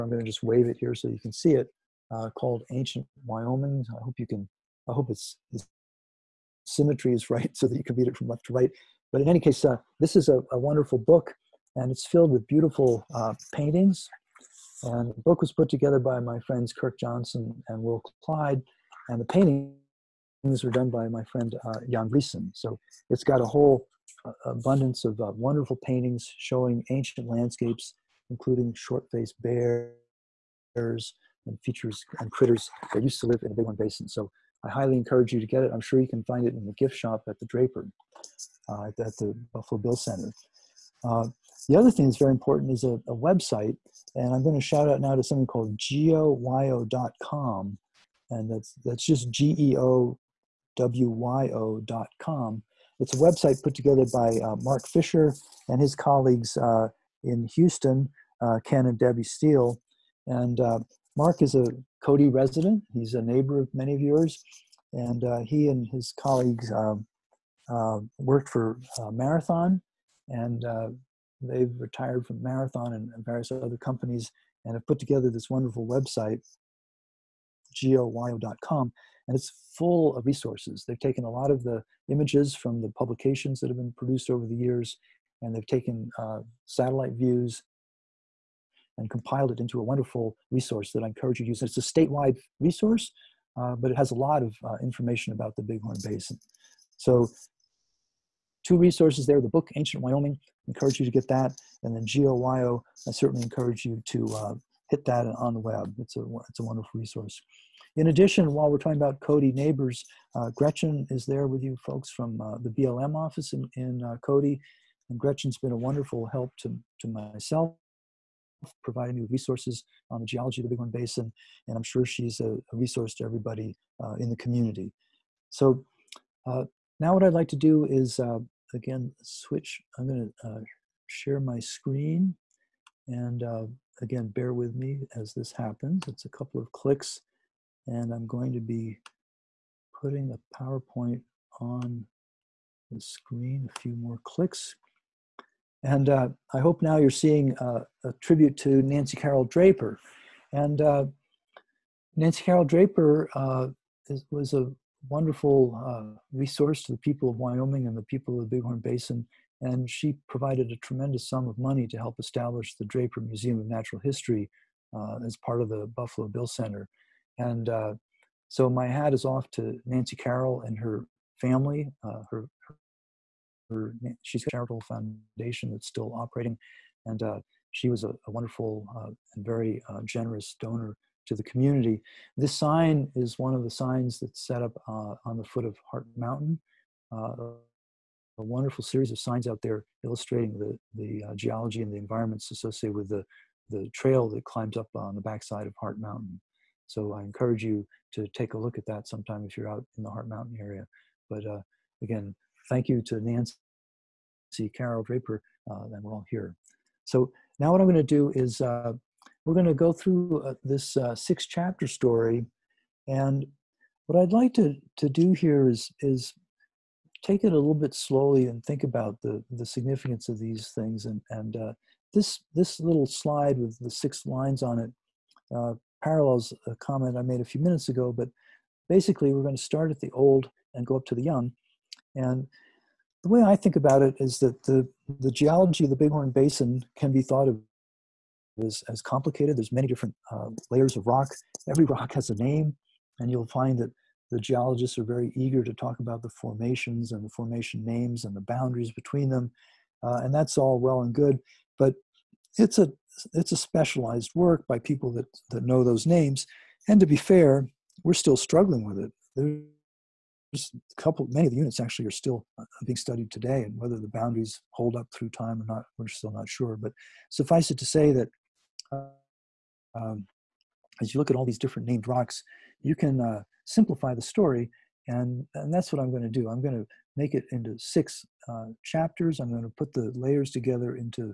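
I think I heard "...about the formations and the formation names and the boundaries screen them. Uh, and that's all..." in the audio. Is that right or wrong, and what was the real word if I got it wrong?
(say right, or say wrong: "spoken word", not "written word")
wrong: "between", not "screen".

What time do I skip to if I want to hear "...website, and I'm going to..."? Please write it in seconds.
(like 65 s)
43 s.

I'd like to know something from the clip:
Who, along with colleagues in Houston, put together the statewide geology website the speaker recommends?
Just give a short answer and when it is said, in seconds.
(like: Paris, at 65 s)
Mark Fisher, at 54 s.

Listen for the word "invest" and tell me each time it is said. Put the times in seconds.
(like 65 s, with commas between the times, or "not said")
not said.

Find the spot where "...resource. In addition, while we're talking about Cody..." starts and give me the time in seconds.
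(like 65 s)
106 s.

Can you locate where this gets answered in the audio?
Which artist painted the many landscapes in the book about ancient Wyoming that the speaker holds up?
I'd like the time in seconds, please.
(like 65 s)
21 s.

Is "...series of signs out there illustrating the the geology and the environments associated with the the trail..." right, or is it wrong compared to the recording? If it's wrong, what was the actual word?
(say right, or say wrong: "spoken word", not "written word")
right.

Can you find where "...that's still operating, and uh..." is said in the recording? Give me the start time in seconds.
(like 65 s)
175 s.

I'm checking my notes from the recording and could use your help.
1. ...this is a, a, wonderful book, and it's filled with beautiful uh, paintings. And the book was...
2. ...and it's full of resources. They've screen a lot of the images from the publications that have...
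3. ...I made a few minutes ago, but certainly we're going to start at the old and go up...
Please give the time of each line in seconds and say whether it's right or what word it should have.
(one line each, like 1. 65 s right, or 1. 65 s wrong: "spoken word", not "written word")
1. 9 s right
2. 79 s wrong: "taken", not "screen"
3. 227 s wrong: "basically", not "certainly".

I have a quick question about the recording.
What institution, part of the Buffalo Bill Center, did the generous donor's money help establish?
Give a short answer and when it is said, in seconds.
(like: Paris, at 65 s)
Draper Museum of Natural History, at 162 s.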